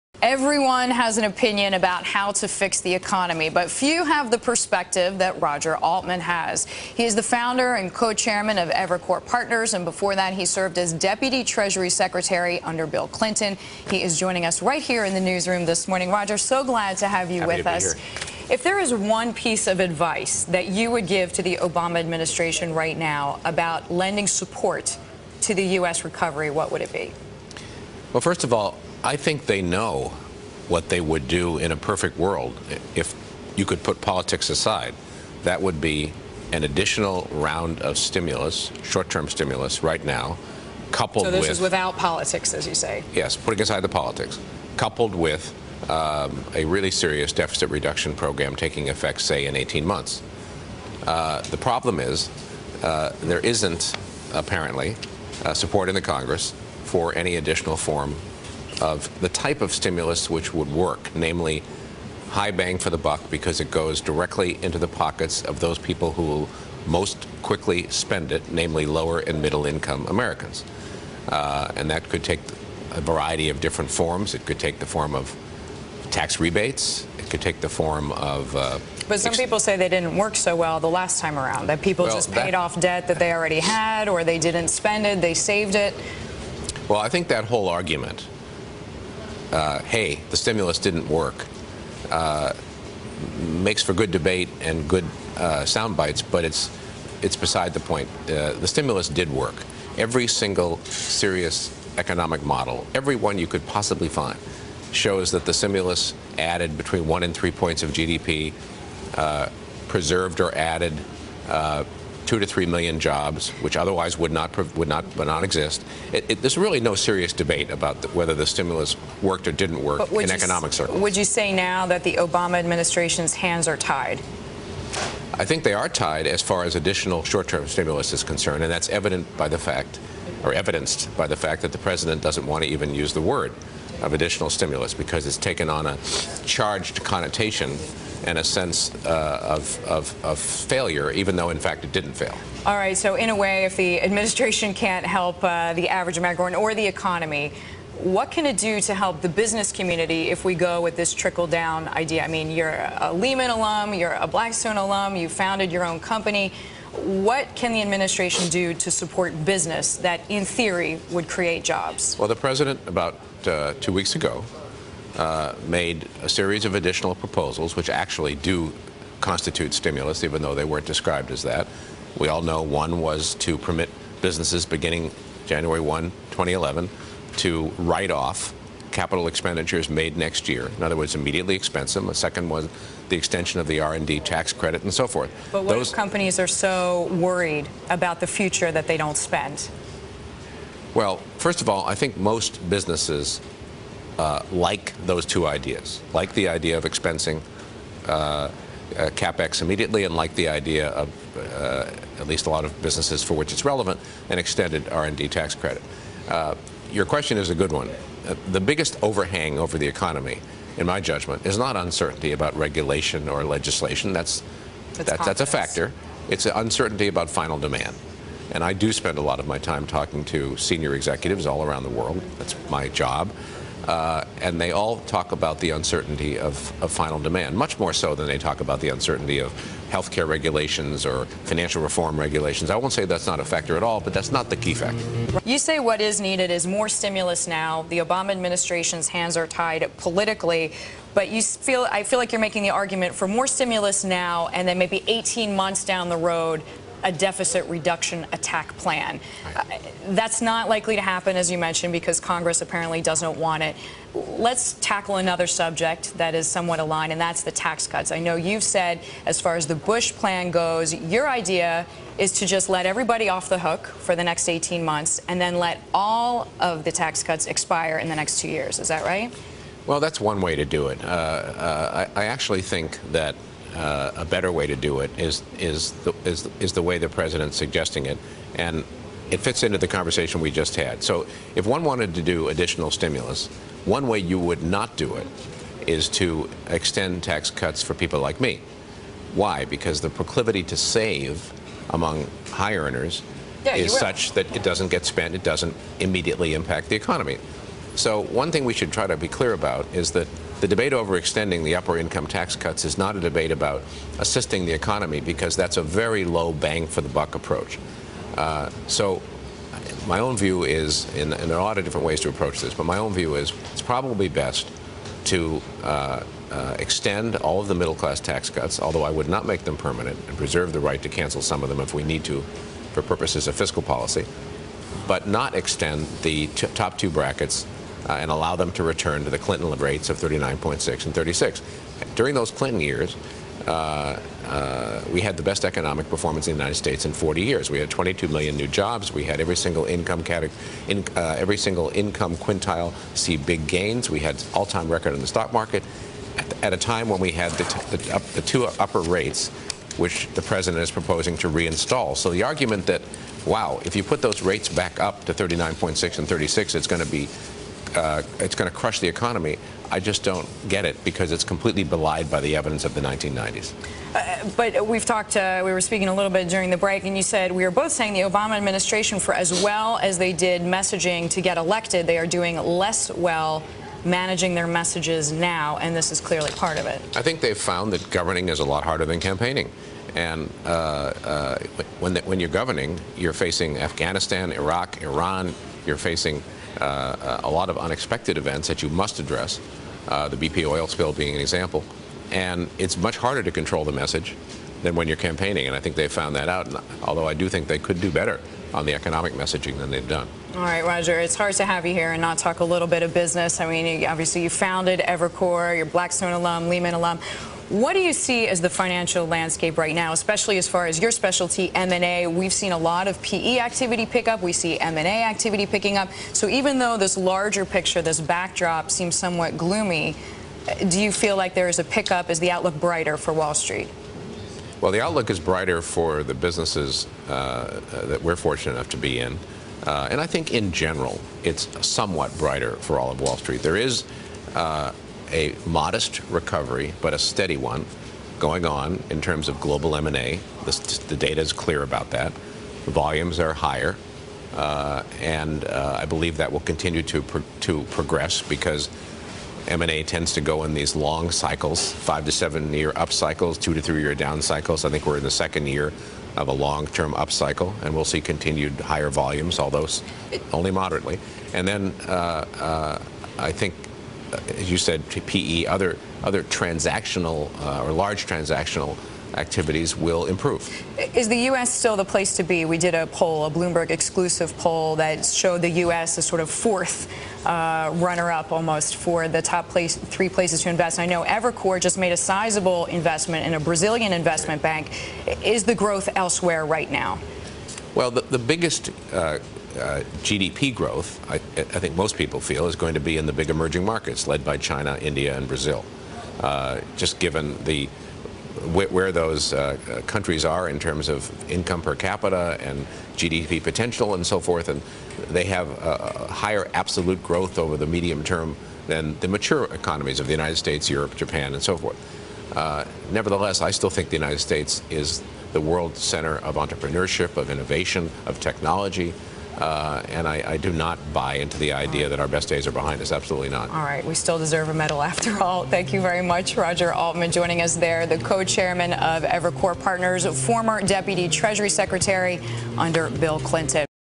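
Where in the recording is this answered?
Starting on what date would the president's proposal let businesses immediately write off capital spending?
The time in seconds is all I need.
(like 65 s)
175 s.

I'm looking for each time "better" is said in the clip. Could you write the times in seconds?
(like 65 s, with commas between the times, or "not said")
274 s, 398 s.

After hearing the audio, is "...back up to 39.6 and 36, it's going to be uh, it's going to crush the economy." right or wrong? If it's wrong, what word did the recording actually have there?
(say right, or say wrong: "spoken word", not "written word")
right.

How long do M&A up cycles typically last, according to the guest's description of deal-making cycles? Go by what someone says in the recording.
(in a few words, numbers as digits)
5 to 7 years.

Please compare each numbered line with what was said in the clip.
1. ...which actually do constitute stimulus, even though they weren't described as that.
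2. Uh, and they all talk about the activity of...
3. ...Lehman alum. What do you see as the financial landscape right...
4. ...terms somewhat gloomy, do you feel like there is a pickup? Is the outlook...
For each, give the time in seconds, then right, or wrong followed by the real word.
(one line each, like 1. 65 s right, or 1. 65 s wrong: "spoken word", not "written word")
1. 167 s right
2. 223 s wrong: "uncertainty", not "activity"
3. 406 s right
4. 418 s wrong: "seems", not "terms".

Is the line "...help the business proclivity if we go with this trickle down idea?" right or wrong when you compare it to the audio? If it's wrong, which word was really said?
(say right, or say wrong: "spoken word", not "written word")
wrong: "community", not "proclivity".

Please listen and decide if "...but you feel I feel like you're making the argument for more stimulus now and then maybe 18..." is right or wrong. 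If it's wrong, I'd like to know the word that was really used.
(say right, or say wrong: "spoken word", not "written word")
right.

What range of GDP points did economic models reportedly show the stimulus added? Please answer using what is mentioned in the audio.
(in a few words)
1 to 3.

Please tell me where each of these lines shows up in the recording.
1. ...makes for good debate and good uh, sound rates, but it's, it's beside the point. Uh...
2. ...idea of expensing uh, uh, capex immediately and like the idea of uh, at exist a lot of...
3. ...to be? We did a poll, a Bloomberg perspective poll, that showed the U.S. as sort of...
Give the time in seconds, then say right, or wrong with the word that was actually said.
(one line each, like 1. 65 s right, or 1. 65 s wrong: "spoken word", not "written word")
1. 93 s wrong: "bites", not "rates"
2. 196 s wrong: "least", not "exist"
3. 472 s wrong: "exclusive", not "perspective".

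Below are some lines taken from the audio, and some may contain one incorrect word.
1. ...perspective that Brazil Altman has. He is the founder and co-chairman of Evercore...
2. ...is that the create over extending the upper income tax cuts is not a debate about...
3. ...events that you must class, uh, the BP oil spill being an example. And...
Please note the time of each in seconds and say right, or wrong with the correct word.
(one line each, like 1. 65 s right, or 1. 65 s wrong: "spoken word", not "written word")
1. 4 s wrong: "Roger", not "Brazil"
2. 299 s wrong: "debate", not "create"
3. 388 s wrong: "address", not "class".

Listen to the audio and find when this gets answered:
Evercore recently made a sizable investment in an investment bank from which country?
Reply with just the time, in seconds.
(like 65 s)
483 s.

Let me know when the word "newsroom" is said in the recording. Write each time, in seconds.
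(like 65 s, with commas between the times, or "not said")
15 s.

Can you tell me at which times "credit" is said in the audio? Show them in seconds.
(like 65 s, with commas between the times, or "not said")
184 s, 205 s.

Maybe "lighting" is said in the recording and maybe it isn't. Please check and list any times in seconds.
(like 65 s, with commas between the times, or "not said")
not said.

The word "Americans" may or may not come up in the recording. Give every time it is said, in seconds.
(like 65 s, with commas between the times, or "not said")
70 s, 146 s.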